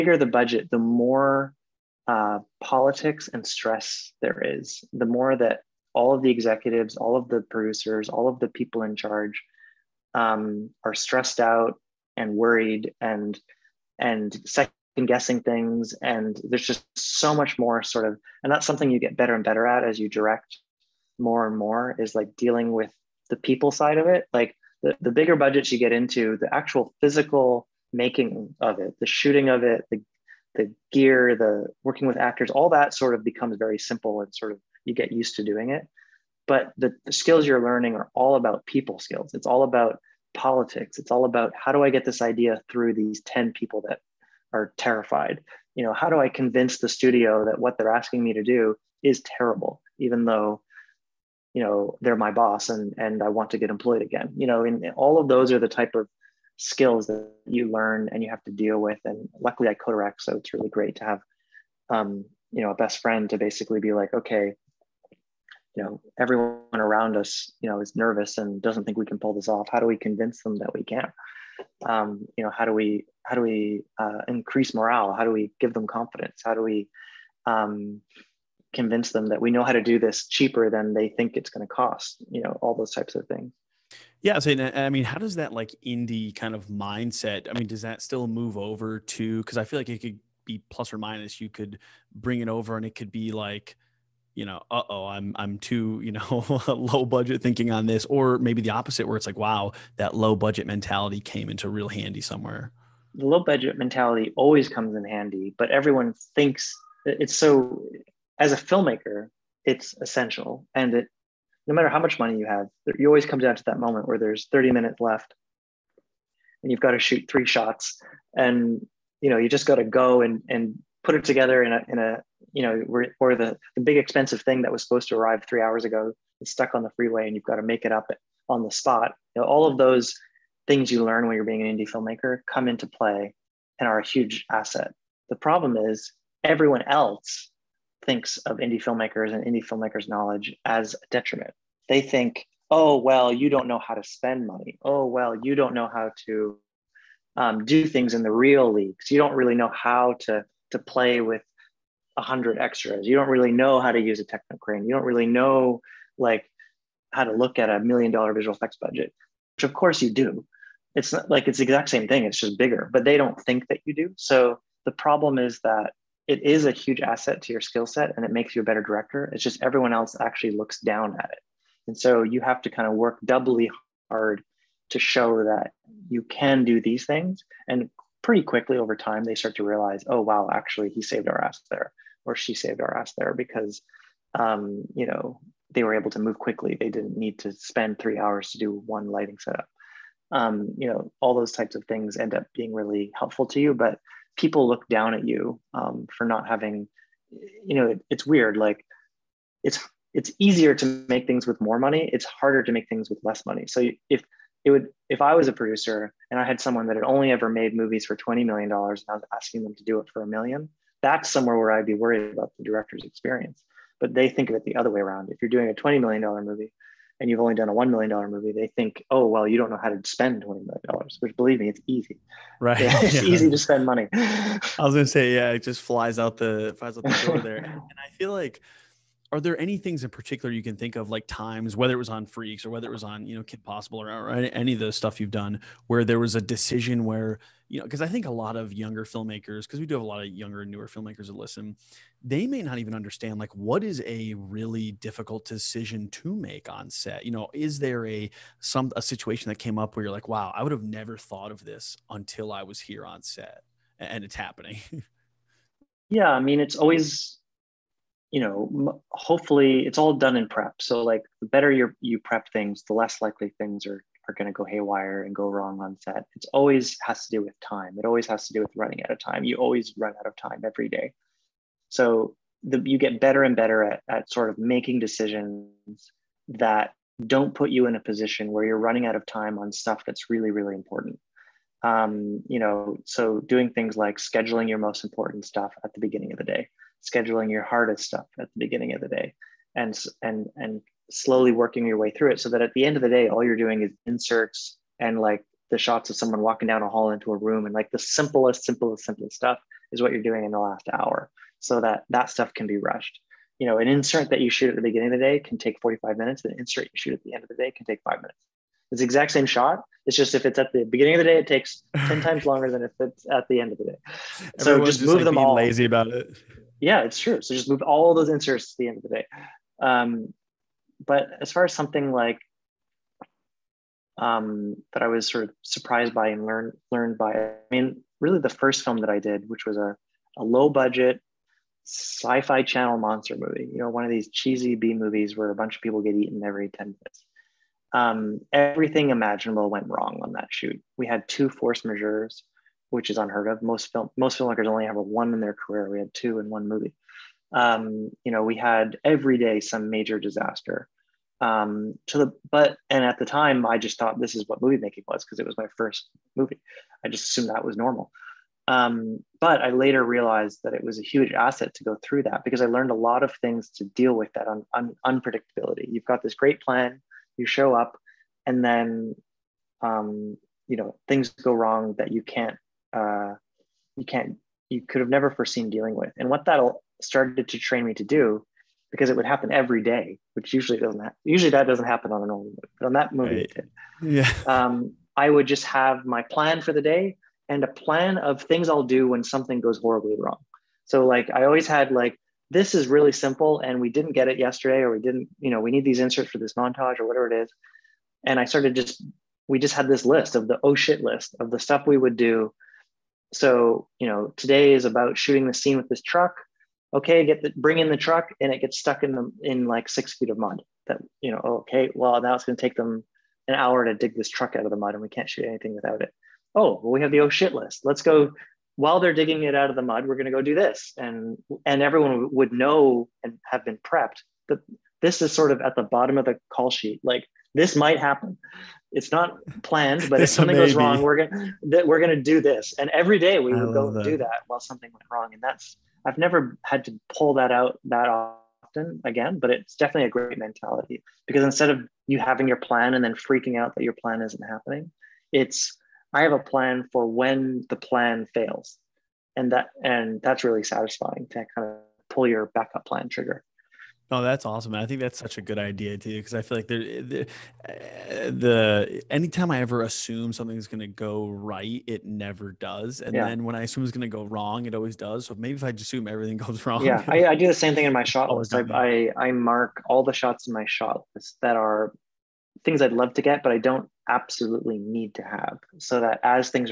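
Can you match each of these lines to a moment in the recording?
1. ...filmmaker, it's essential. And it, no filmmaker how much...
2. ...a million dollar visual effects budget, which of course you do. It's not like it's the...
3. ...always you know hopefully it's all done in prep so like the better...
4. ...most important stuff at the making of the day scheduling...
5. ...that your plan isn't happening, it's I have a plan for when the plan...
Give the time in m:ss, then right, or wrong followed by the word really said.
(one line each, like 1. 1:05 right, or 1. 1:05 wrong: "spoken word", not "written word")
1. 1:48 wrong: "matter", not "filmmaker"
2. 2:37 right
3. 4:16 right
4. 4:44 wrong: "beginning", not "making"
5. 7:23 right.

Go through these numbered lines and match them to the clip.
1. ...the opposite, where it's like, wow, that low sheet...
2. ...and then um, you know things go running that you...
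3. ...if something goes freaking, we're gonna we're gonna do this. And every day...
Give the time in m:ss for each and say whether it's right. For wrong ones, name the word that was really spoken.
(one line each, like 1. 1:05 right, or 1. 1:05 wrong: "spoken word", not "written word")
1. 1:38 wrong: "budget", not "sheet"
2. 6:08 wrong: "wrong", not "running"
3. 7:10 wrong: "wrong", not "freaking".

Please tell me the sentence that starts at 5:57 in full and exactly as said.
I just assumed that was normal.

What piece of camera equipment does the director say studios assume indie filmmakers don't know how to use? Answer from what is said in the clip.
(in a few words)
Technocrane.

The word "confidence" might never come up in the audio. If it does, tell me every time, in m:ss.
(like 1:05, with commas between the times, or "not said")
1:15.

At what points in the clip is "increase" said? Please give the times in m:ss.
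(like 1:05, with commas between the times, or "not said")
1:14.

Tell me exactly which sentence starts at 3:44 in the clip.
I was going to say, yeah, it just flies out the, flies out the door there.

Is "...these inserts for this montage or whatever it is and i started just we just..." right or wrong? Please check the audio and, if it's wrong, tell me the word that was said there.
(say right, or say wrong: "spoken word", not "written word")
right.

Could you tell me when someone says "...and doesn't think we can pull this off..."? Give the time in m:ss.
1:08.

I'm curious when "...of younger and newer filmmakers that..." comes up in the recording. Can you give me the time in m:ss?
4:00.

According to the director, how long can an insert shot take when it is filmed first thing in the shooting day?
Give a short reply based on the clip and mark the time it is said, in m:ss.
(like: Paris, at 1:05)
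45 minutes, at 5:05.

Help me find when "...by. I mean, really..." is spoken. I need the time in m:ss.
5:27.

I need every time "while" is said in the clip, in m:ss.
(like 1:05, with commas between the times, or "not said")
6:58, 7:14.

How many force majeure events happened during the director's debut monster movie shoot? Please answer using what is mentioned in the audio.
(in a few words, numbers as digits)
2.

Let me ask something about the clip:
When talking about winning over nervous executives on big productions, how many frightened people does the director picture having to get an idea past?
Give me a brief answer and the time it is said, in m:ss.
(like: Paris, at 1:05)
10, at 0:43.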